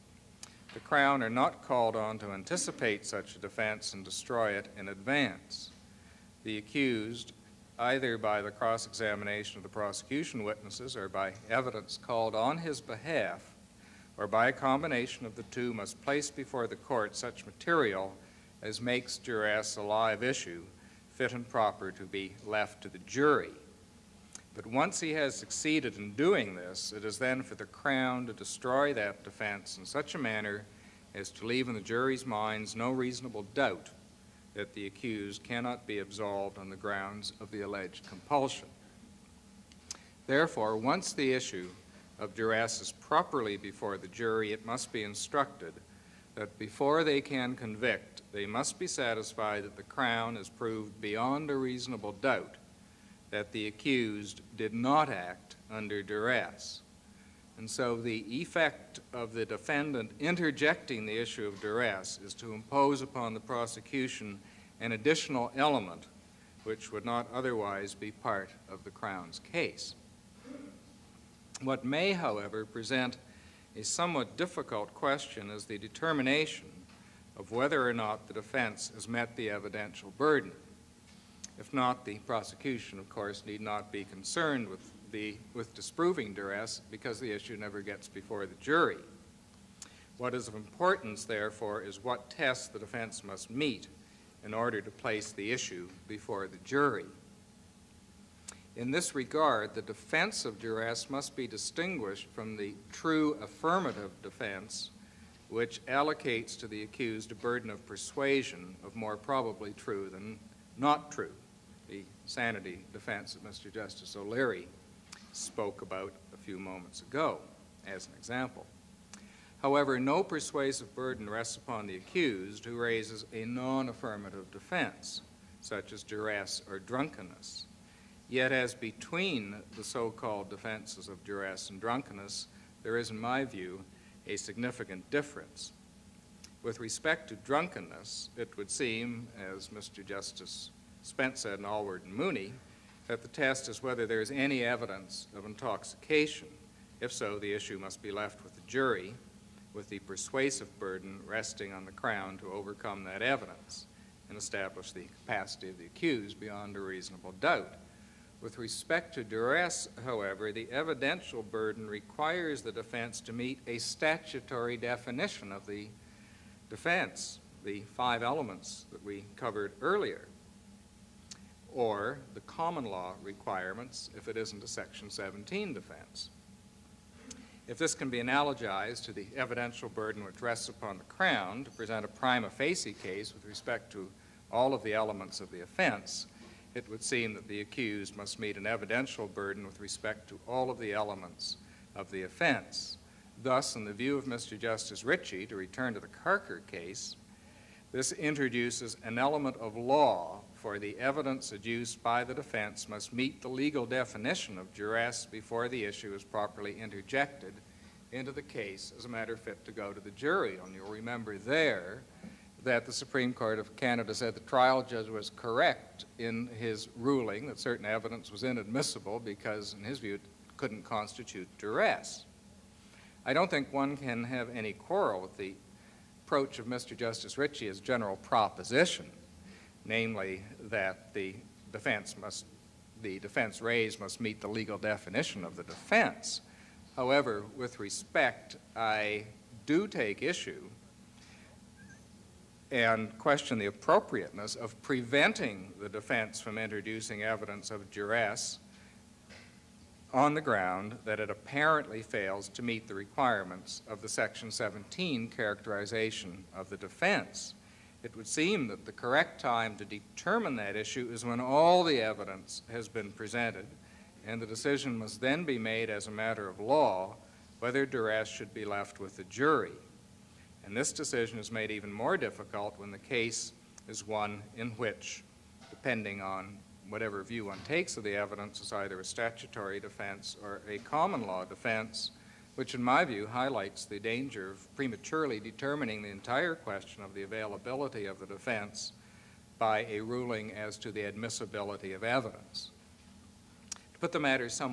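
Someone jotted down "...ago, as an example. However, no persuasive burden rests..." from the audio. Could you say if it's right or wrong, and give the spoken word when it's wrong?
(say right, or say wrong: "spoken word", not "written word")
right.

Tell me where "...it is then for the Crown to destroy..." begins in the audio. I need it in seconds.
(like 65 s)
26 s.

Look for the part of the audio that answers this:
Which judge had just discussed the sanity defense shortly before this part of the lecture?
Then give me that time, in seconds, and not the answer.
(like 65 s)
113 s.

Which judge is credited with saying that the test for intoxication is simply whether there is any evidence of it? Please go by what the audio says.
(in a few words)
Justice Spence.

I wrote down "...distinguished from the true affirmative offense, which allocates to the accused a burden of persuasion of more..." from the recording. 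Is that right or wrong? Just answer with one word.
wrong.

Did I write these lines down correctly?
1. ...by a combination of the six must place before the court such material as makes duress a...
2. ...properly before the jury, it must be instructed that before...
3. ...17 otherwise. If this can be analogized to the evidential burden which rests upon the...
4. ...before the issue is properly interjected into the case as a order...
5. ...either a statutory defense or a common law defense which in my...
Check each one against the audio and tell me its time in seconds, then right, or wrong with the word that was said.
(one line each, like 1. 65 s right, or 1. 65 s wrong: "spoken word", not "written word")
1. 14 s wrong: "two", not "six"
2. 42 s right
3. 175 s wrong: "defense", not "otherwise"
4. 205 s wrong: "matter", not "order"
5. 278 s right.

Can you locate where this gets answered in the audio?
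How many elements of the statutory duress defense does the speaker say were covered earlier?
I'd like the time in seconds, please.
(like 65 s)
167 s.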